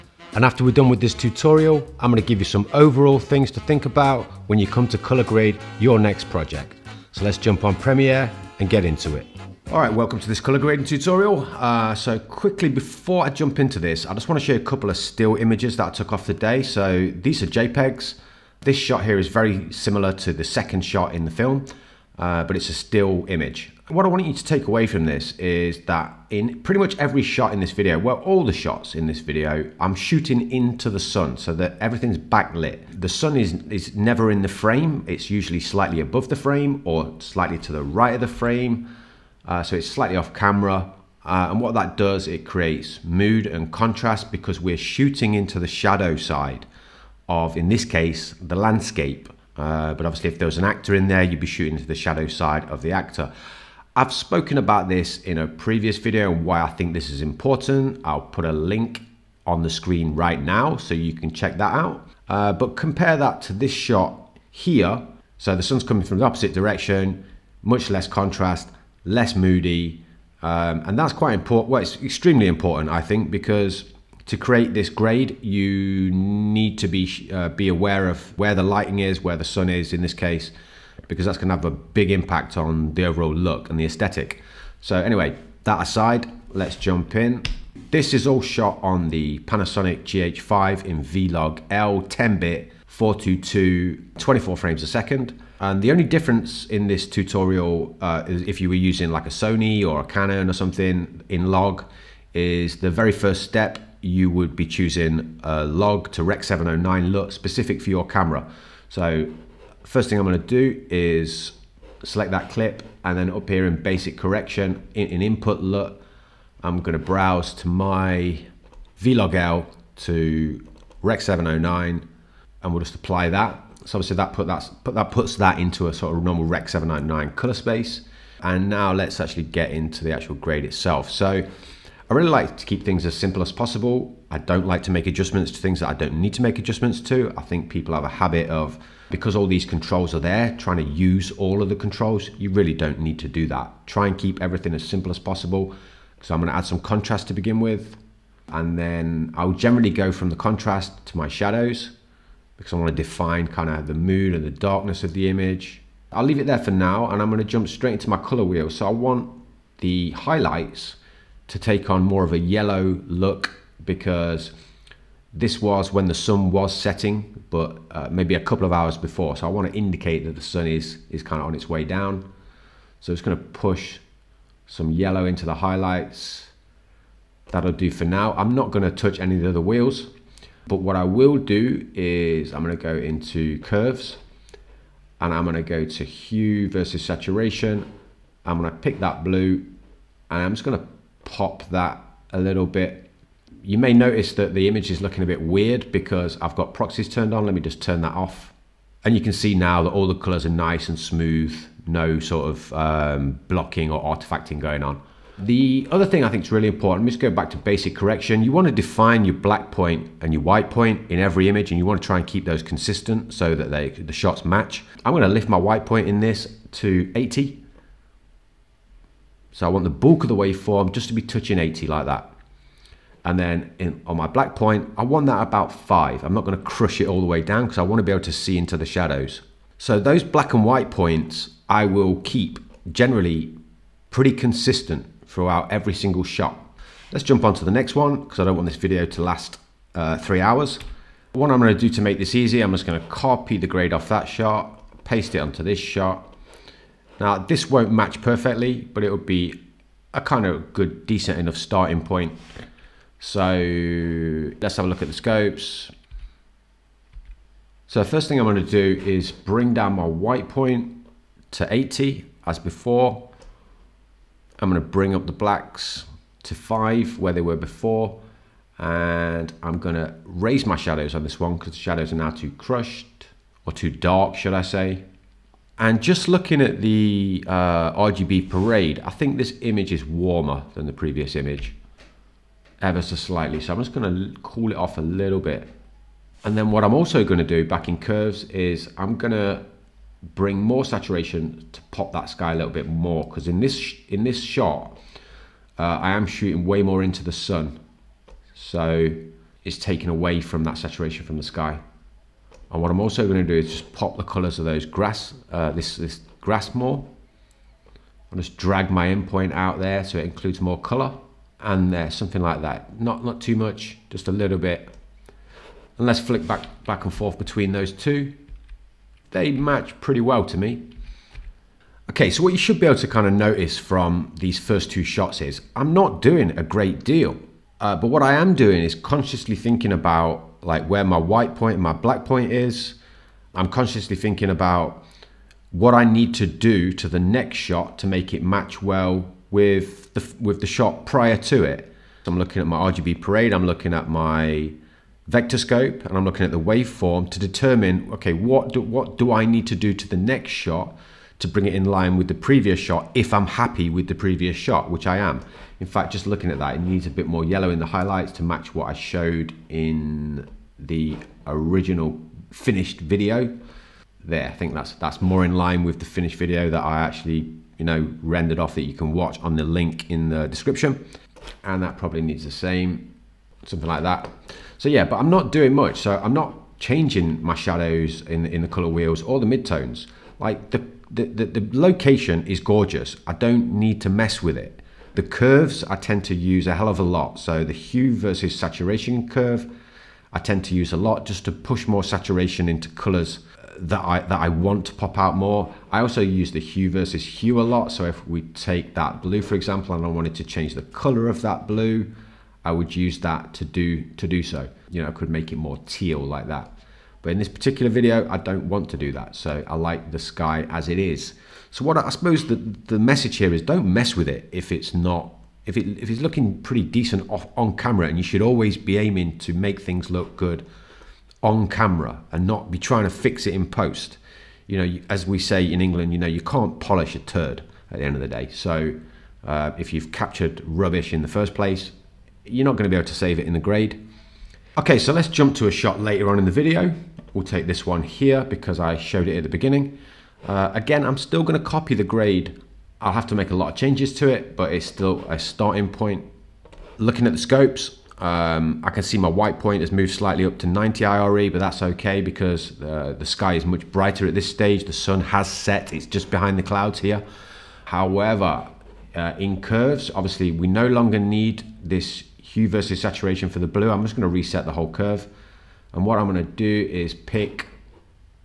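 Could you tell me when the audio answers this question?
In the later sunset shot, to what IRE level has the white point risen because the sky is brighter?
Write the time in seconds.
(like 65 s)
450 s.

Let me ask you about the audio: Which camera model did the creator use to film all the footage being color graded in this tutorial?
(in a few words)
Panasonic GH5.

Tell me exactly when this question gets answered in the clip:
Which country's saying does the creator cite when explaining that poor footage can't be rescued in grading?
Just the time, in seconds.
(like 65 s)
425 s.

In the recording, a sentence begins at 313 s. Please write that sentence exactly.
Not, not too much, just a little bit.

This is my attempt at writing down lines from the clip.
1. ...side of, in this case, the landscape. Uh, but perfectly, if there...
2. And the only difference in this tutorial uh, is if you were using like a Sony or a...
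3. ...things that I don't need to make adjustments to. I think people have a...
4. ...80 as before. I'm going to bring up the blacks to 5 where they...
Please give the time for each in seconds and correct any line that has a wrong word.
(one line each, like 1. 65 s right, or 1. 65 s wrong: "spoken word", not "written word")
1. 46 s wrong: "obviously", not "perfectly"
2. 95 s right
3. 135 s right
4. 261 s right.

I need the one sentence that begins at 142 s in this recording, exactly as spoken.
You really don't need to do that.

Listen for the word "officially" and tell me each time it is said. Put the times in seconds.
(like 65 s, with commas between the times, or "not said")
not said.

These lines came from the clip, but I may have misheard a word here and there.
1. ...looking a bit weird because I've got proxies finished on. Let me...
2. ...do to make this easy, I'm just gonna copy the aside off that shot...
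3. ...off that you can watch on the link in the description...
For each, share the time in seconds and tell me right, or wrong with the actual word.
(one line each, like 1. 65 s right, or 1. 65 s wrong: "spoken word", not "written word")
1. 195 s wrong: "turned", not "finished"
2. 241 s wrong: "grade", not "aside"
3. 368 s right.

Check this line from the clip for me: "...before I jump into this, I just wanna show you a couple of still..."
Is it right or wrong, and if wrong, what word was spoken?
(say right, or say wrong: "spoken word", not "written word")
right.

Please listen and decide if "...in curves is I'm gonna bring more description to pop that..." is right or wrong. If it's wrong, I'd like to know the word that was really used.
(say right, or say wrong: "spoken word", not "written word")
wrong: "saturation", not "description".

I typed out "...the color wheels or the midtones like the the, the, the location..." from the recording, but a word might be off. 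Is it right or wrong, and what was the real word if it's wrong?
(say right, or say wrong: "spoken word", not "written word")
right.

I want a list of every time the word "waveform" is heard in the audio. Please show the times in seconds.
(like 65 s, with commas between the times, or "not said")
220 s, 346 s.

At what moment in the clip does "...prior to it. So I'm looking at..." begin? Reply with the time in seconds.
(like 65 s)
341 s.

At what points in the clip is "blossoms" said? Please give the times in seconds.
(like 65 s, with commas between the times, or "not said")
not said.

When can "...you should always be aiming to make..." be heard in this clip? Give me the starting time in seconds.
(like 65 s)
418 s.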